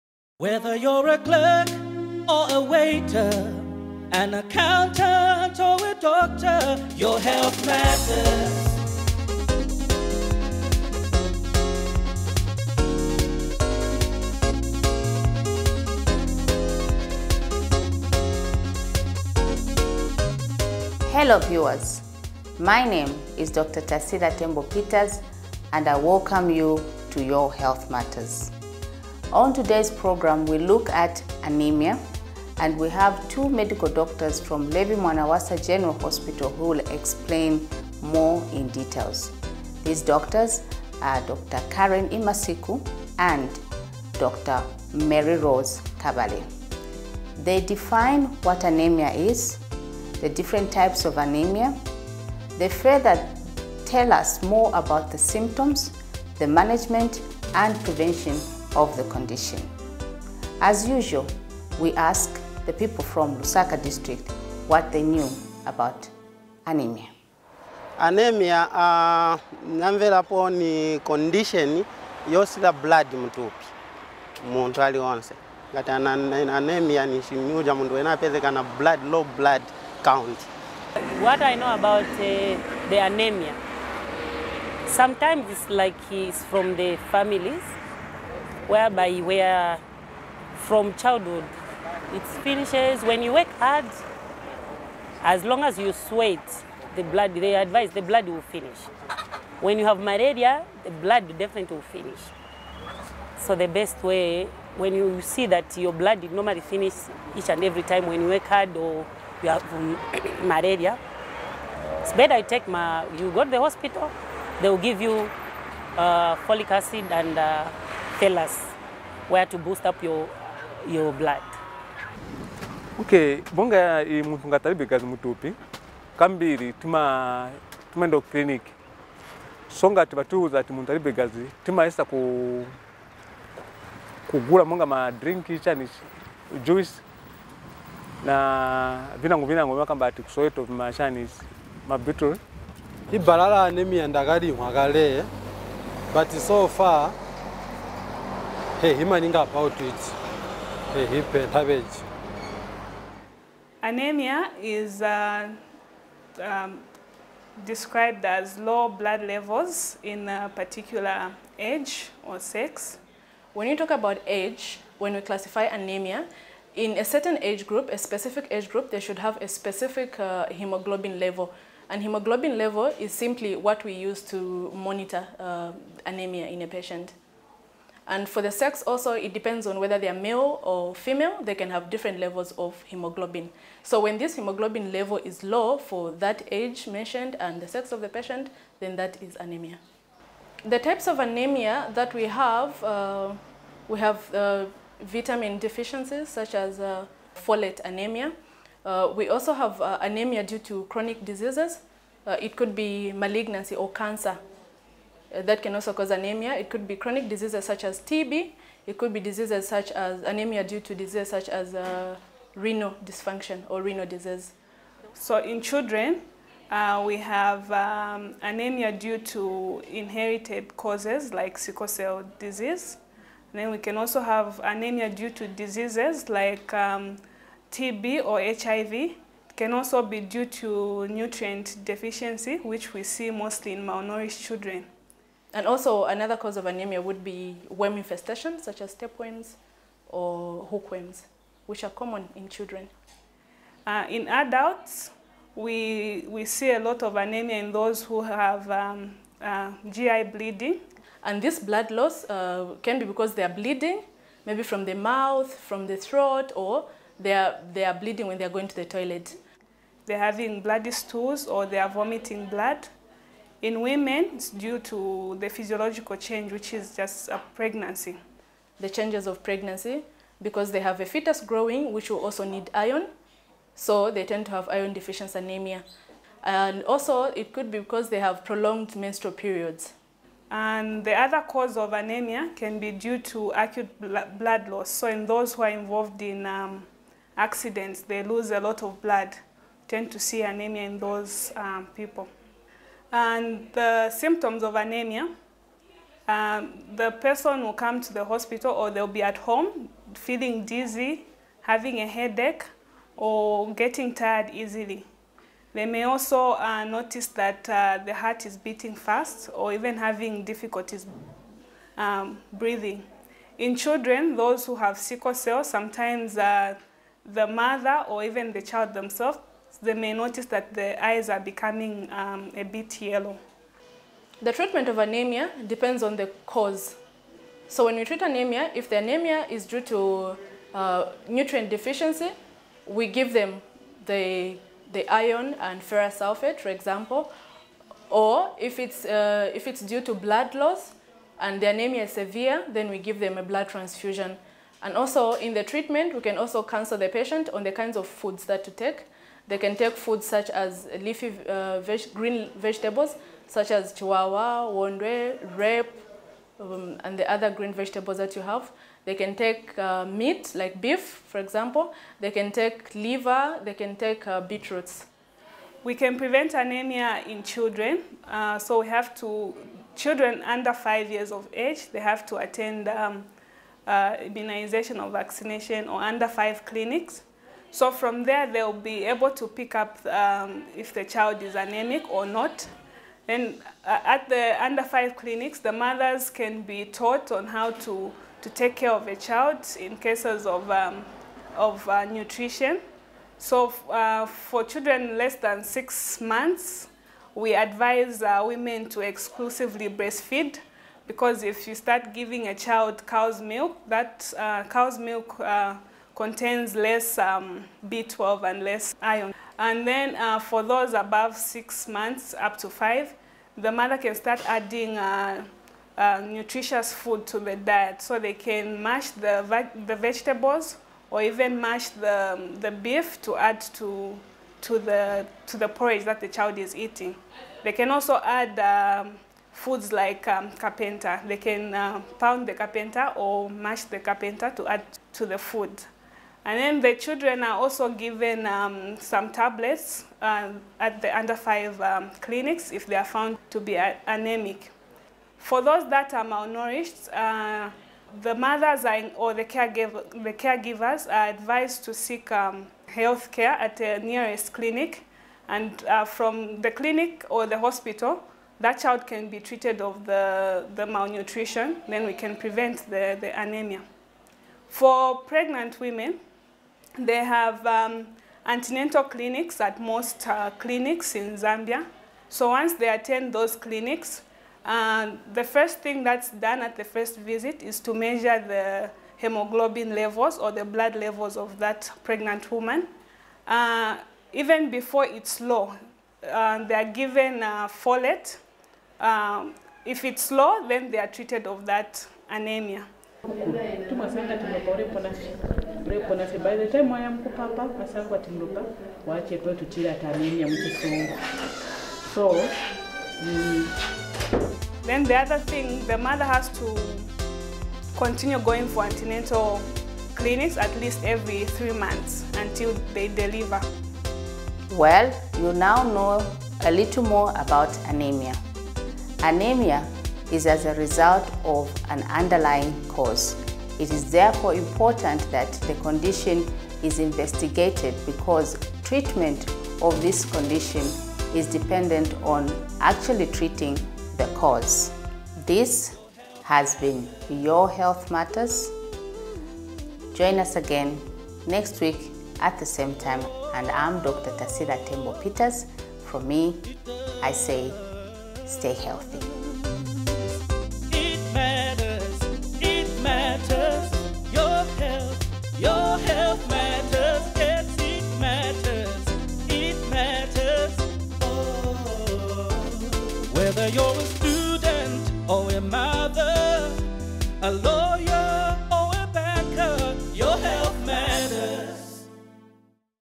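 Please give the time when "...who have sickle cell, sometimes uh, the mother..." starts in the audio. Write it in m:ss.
5:14.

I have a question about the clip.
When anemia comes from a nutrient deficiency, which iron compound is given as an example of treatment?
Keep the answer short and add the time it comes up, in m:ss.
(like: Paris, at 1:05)
Ferrous sulfate, at 5:35.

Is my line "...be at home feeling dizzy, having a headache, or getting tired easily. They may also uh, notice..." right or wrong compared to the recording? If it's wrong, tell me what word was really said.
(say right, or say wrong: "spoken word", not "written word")
right.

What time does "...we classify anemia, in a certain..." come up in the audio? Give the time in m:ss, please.
2:45.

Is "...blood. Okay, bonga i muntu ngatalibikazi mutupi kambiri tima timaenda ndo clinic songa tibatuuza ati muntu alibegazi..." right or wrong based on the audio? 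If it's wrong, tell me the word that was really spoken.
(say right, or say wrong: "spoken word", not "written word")
right.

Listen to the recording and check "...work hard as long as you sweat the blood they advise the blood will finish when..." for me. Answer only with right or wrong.
right.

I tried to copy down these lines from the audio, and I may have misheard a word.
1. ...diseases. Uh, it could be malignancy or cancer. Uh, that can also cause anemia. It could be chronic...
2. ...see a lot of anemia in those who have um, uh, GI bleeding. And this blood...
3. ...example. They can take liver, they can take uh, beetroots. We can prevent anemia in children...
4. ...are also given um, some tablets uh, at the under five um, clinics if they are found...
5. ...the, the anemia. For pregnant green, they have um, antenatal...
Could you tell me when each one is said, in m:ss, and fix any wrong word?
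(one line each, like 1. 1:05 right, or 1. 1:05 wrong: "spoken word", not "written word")
1. 3:21 right
2. 4:06 right
3. 6:01 right
4. 7:17 right
5. 7:42 wrong: "women", not "green".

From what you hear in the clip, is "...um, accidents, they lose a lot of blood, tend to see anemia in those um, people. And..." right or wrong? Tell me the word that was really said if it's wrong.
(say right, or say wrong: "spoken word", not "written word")
right.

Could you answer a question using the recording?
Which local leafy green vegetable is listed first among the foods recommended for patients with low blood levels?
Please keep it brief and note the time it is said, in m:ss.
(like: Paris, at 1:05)
Chibwabwa, at 5:53.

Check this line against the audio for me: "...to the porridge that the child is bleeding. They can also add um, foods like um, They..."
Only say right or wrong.
wrong.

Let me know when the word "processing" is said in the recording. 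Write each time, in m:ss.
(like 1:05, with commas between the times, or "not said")
not said.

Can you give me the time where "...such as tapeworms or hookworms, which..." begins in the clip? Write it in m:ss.
3:58.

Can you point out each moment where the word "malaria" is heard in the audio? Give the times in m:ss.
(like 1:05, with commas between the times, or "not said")
1:39, 1:50.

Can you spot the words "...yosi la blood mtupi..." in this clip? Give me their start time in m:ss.
1:12.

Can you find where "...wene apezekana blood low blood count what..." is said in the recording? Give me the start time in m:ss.
1:17.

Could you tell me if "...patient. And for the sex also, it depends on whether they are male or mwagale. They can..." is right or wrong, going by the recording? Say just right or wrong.
wrong.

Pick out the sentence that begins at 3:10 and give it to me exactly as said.
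The types of anemia that we have, uh, we have uh, vitamin deficiencies such as uh, folate anemia.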